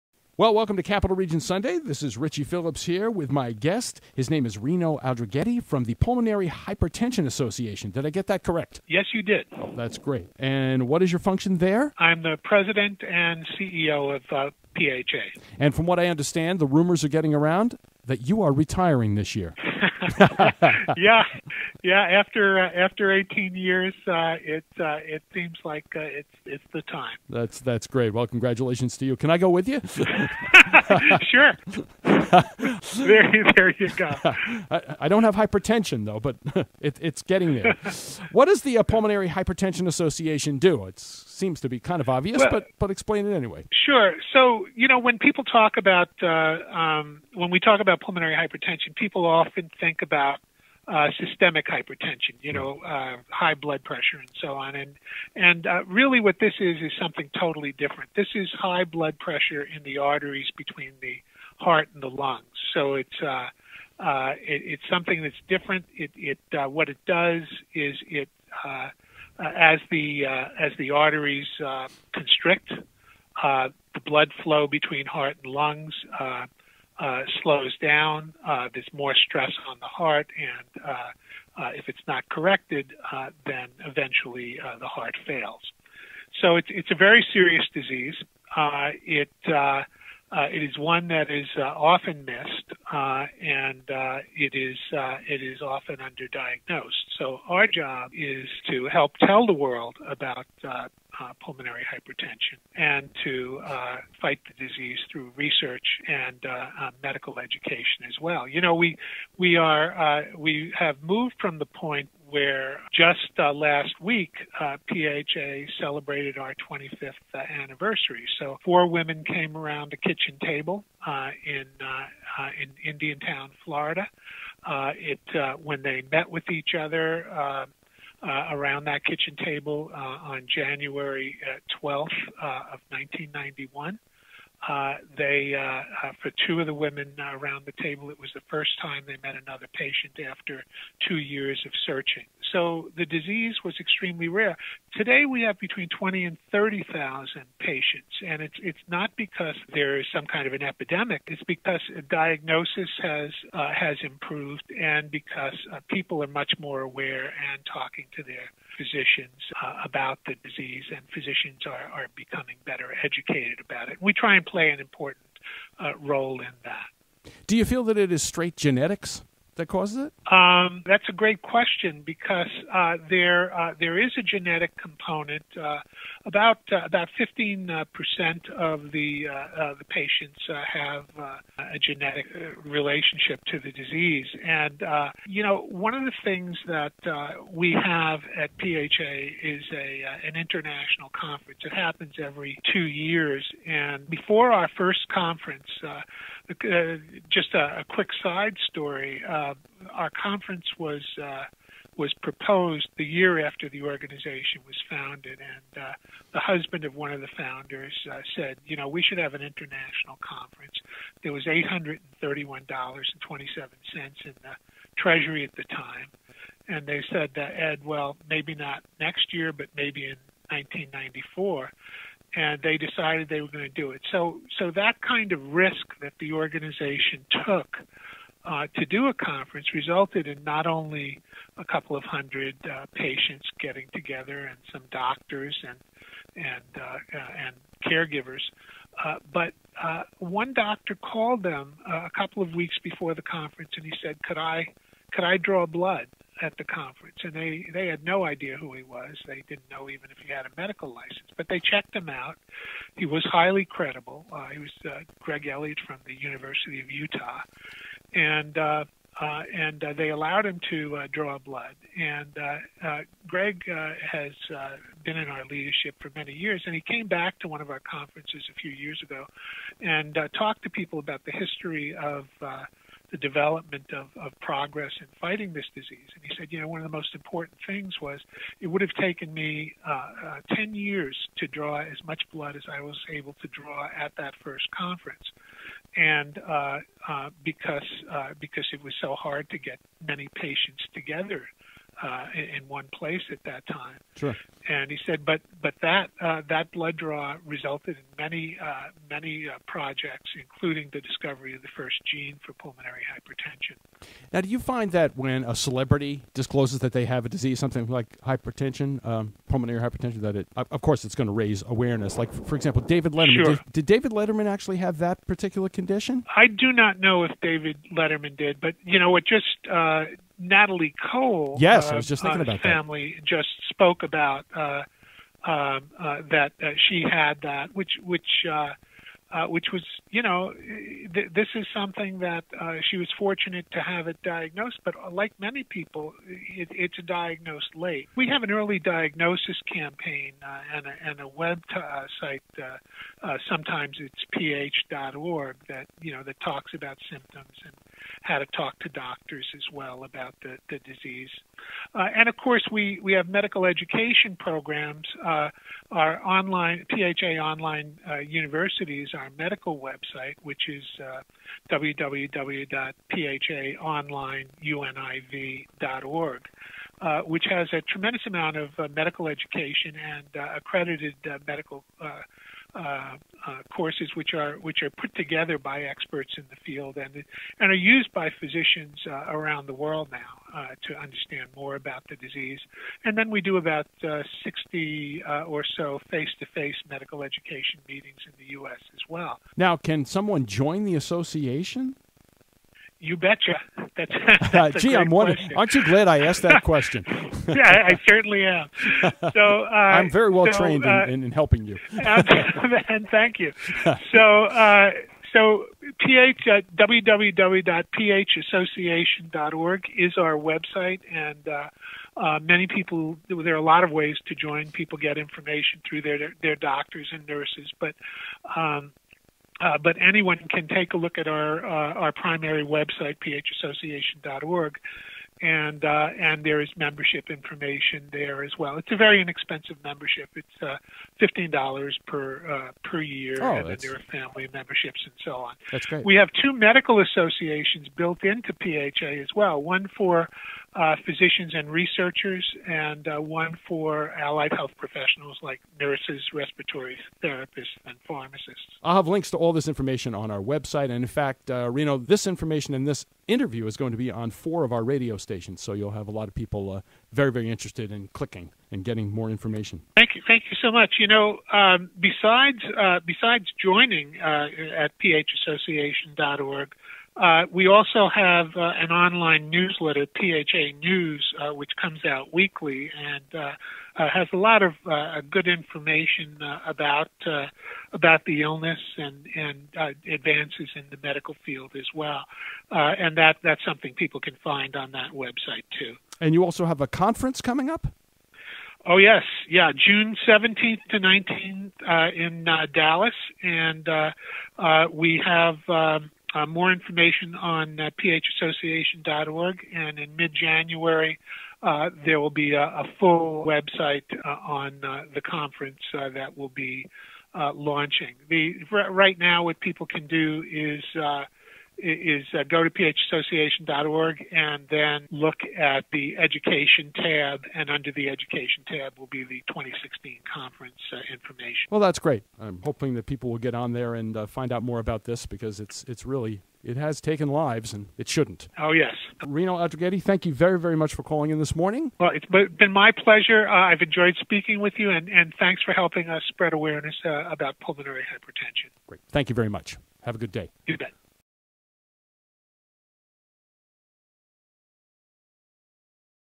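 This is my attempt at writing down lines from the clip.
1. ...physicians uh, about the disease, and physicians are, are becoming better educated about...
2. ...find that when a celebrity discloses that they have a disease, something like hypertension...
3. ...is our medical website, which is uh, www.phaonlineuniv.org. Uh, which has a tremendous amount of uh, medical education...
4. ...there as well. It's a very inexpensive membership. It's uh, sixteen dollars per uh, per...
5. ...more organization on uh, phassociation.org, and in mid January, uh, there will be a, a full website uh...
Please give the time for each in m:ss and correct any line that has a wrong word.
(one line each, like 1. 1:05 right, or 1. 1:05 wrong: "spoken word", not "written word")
1. 2:38 right
2. 5:04 right
3. 5:59 right
4. 7:08 wrong: "fifteen", not "sixteen"
5. 8:16 wrong: "information", not "organization".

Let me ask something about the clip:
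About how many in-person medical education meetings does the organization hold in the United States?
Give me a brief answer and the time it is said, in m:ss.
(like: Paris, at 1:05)
60, at 6:24.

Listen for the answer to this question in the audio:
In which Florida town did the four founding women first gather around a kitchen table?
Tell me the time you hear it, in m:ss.
2:02.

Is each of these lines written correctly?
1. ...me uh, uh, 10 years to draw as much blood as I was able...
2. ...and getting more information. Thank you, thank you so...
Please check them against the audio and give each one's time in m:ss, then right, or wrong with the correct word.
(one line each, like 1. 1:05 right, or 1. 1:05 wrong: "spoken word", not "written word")
1. 4:39 right
2. 7:38 right.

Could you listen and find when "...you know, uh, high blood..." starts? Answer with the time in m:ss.
0:52.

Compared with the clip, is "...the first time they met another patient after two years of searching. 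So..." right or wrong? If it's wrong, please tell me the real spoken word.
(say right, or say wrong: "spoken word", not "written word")
right.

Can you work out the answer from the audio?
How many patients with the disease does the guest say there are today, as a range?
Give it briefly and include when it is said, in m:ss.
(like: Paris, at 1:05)
20,000 to 30,000, at 2:25.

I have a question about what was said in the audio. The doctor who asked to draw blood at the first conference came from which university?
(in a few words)
University of Utah.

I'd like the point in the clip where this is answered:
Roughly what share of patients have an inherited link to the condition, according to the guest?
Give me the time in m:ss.
2:57.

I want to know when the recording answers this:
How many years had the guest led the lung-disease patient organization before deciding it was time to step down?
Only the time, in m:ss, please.
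0:23.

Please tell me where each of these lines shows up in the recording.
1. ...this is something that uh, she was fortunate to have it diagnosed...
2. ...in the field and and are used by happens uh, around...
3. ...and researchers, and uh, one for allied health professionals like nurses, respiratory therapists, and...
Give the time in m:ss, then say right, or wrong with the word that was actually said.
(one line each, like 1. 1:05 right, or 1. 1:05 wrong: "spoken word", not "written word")
1. 5:31 right
2. 6:16 wrong: "physicians", not "happens"
3. 7:21 right.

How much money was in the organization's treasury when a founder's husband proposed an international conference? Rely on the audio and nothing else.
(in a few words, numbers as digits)
$831.27.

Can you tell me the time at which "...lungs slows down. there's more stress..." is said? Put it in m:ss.
1:15.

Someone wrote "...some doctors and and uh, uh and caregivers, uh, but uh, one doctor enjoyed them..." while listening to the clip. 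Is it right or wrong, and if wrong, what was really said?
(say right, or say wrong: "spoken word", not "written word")
wrong: "called", not "enjoyed".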